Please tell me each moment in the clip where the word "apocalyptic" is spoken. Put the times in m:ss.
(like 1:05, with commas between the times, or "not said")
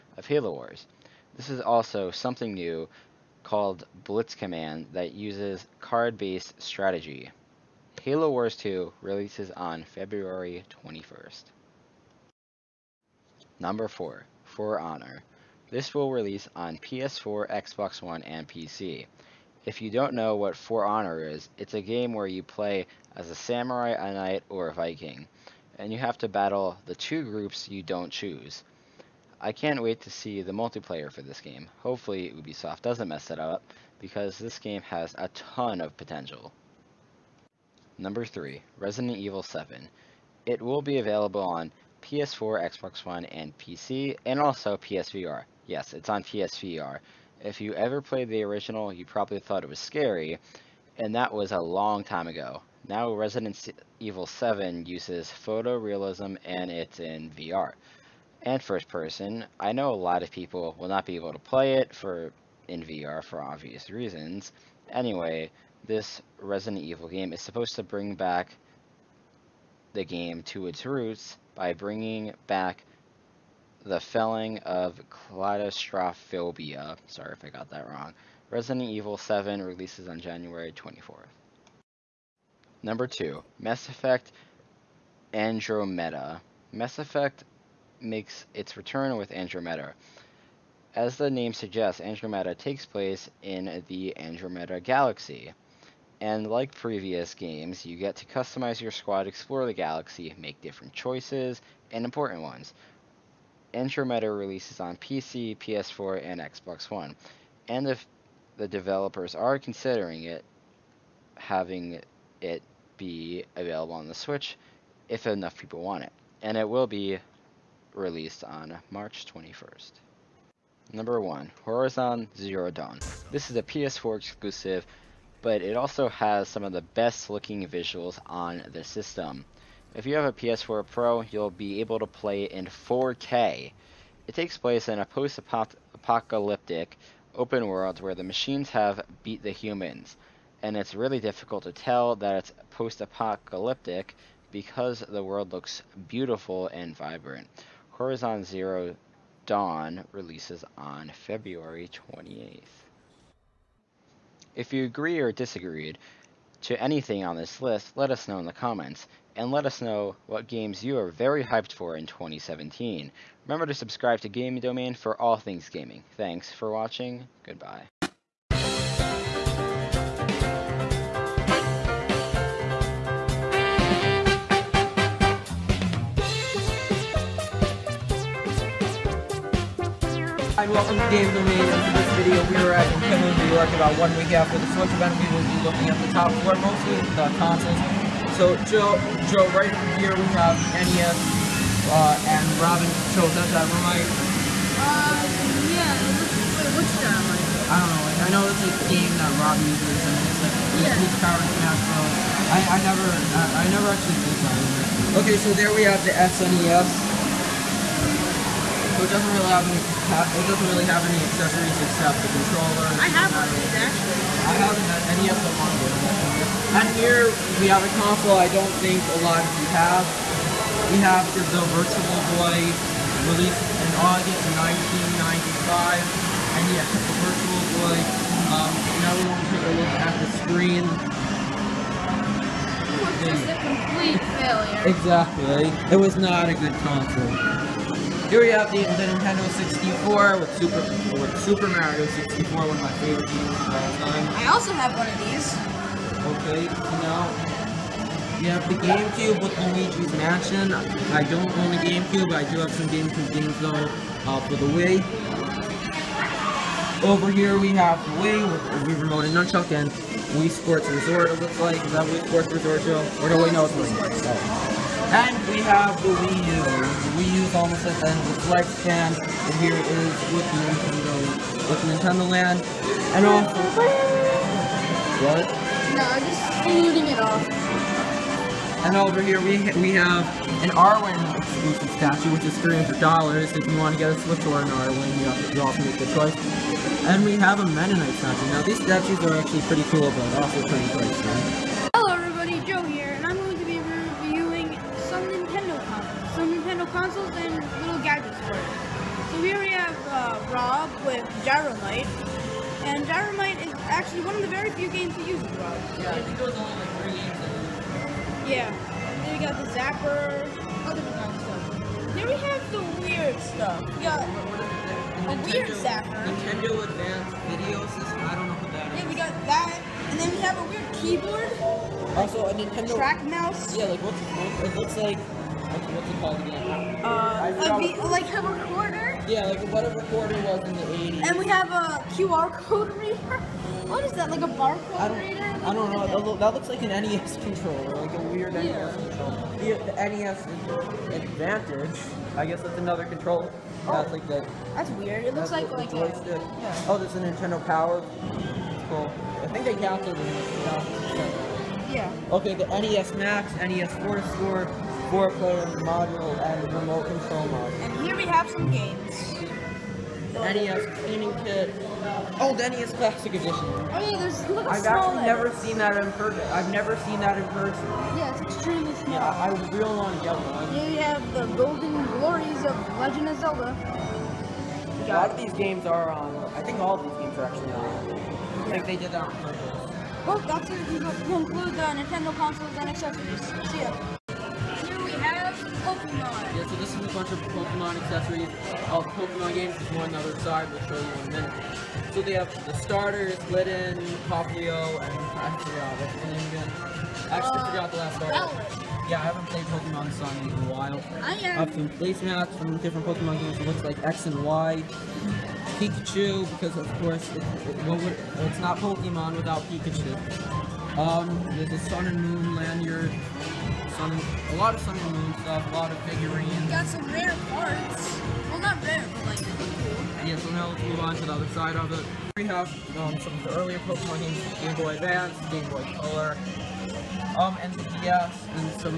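2:15, 2:22.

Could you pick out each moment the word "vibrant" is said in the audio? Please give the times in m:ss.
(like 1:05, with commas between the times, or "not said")
2:26.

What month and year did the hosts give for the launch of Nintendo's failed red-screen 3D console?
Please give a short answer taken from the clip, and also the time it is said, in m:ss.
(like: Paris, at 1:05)
August 1995, at 3:43.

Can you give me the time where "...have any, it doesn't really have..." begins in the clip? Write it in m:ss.
3:29.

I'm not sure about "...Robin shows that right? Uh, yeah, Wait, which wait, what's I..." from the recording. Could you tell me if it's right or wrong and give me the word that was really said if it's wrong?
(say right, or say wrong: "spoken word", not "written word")
right.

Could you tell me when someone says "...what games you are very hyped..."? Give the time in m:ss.
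2:40.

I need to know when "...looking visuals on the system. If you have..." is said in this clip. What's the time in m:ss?
2:07.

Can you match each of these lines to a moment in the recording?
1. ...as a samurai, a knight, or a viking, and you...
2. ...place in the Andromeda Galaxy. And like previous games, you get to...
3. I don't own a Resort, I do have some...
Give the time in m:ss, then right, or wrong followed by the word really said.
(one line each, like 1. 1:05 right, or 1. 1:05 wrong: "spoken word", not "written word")
1. 0:23 right
2. 1:32 right
3. 4:10 wrong: "GameCube", not "Resort".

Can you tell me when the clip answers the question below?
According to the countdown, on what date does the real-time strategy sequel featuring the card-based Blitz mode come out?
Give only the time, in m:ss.
0:09.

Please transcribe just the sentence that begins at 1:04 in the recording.
Anyway, this Resident Evil game is supposed to bring back the game to its roots by bringing back the felling of Kaleidostrophobia.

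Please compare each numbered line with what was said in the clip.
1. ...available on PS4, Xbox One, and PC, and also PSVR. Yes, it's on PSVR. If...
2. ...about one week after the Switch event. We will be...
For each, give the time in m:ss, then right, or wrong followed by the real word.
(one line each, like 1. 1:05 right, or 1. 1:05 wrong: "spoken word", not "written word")
1. 0:40 right
2. 3:03 right.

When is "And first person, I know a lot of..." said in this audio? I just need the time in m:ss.
0:58.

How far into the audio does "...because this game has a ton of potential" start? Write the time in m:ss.
0:33.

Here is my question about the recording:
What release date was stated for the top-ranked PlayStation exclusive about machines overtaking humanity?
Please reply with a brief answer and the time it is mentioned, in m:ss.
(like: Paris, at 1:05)
February 28th, at 2:31.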